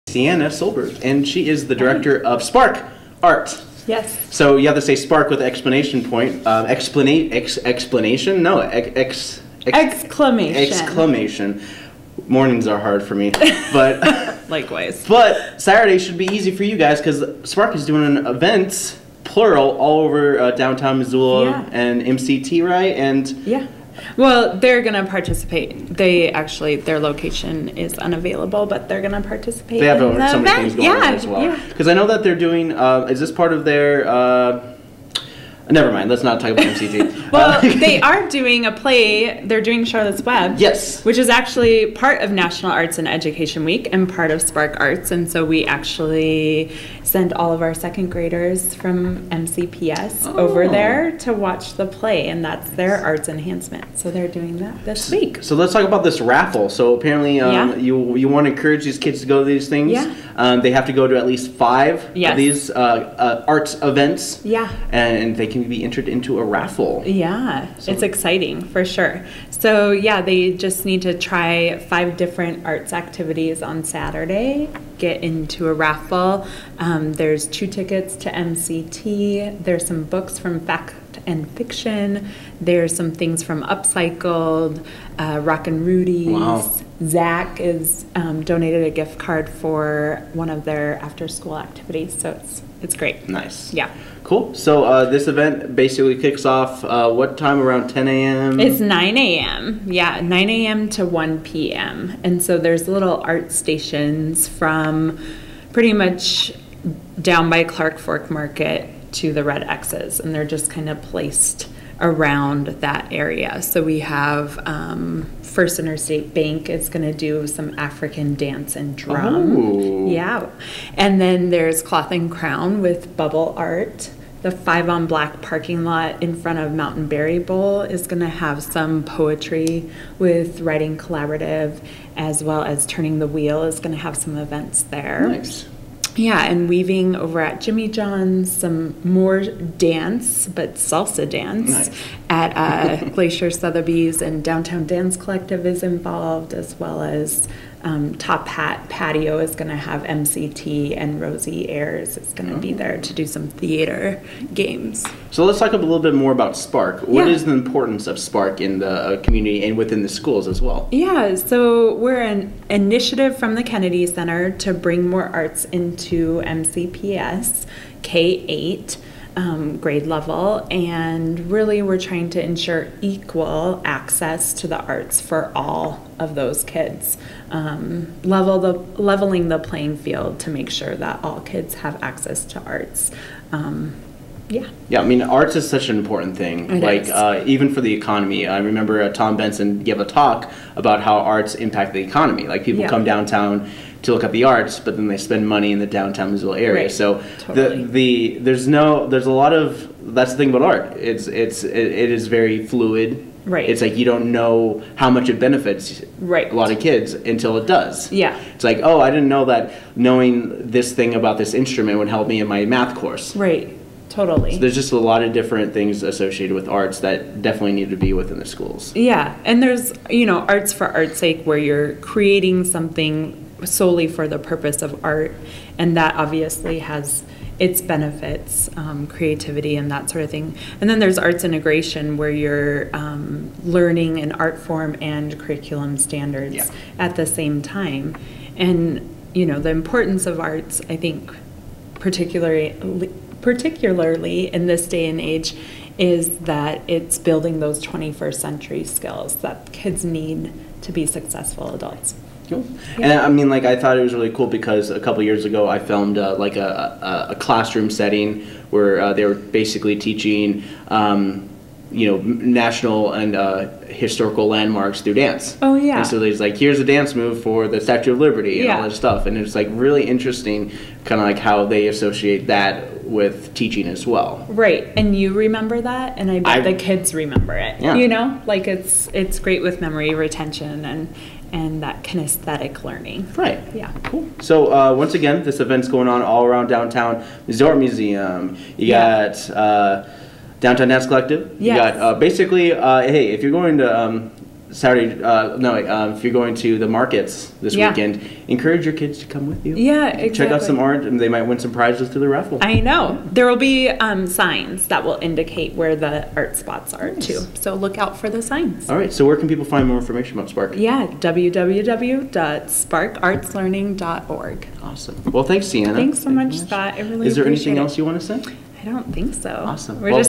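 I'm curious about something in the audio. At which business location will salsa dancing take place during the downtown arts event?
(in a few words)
Glacier Sotheby's.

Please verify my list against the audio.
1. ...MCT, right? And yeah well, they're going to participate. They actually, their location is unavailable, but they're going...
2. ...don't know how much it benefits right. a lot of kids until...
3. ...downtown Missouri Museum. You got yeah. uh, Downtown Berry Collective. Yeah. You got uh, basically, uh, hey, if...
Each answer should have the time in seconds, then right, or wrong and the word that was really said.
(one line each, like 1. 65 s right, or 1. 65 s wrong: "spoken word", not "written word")
1. 22 s right
2. 204 s right
3. 286 s wrong: "Dance", not "Berry".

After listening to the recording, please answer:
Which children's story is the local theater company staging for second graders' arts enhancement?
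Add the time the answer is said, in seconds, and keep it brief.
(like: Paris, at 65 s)
Charlotte's Web, at 39 s.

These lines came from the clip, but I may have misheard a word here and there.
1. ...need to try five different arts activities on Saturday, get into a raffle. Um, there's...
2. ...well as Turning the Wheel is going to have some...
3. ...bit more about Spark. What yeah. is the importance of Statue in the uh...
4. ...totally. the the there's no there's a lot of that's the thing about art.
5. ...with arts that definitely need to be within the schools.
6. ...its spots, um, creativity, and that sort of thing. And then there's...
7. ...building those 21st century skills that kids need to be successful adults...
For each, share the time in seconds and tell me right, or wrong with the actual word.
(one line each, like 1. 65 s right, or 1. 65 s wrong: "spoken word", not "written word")
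1. 70 s right
2. 132 s right
3. 155 s wrong: "Spark", not "Statue"
4. 197 s right
5. 216 s right
6. 227 s wrong: "benefits", not "spots"
7. 247 s right.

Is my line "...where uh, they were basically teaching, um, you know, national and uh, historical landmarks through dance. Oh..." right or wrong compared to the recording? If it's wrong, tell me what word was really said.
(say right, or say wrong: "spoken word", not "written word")
right.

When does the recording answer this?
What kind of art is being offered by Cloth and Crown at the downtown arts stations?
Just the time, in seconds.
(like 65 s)
123 s.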